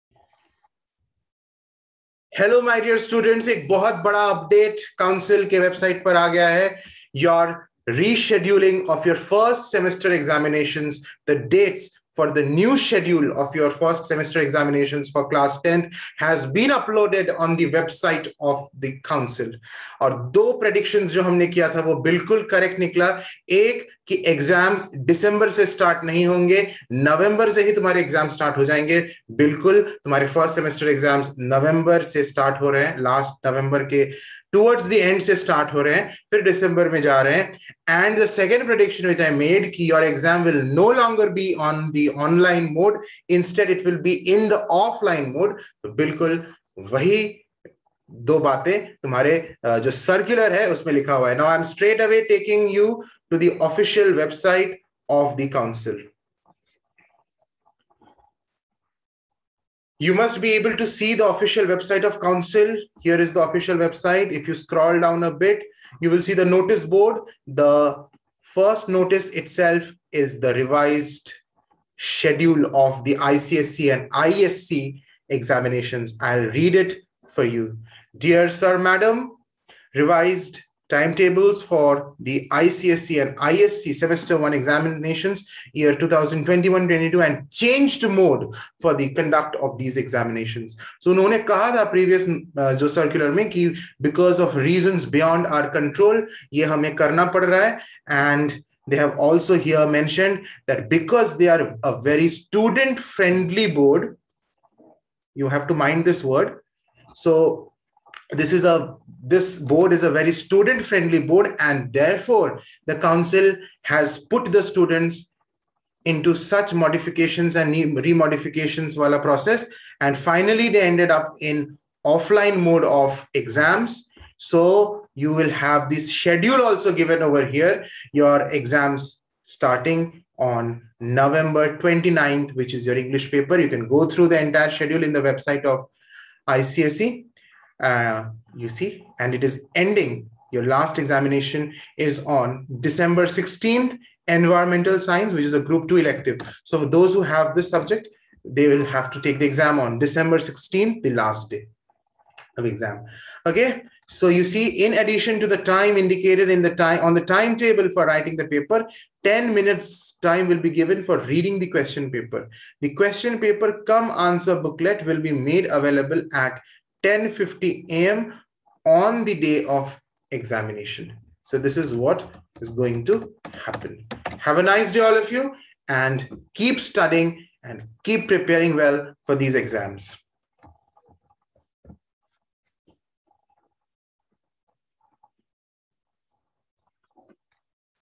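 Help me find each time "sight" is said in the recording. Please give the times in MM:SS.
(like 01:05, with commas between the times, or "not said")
not said.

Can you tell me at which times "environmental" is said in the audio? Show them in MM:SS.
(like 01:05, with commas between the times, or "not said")
02:24.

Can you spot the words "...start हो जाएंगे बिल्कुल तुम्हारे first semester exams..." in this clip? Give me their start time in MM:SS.
00:28.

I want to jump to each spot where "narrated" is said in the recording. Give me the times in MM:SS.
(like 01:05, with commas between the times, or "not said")
not said.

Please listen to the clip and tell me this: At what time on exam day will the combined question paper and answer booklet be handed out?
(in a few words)
10:50 a.m.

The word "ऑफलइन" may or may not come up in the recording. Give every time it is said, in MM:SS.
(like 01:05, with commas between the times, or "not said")
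00:44.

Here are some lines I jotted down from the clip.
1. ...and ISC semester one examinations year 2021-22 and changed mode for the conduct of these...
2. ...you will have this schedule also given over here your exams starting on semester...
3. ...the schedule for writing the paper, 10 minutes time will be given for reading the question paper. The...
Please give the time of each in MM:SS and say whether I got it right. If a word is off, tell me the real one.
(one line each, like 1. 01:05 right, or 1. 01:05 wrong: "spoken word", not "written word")
1. 01:23 right
2. 02:05 wrong: "november", not "semester"
3. 02:37 wrong: "timetable", not "schedule".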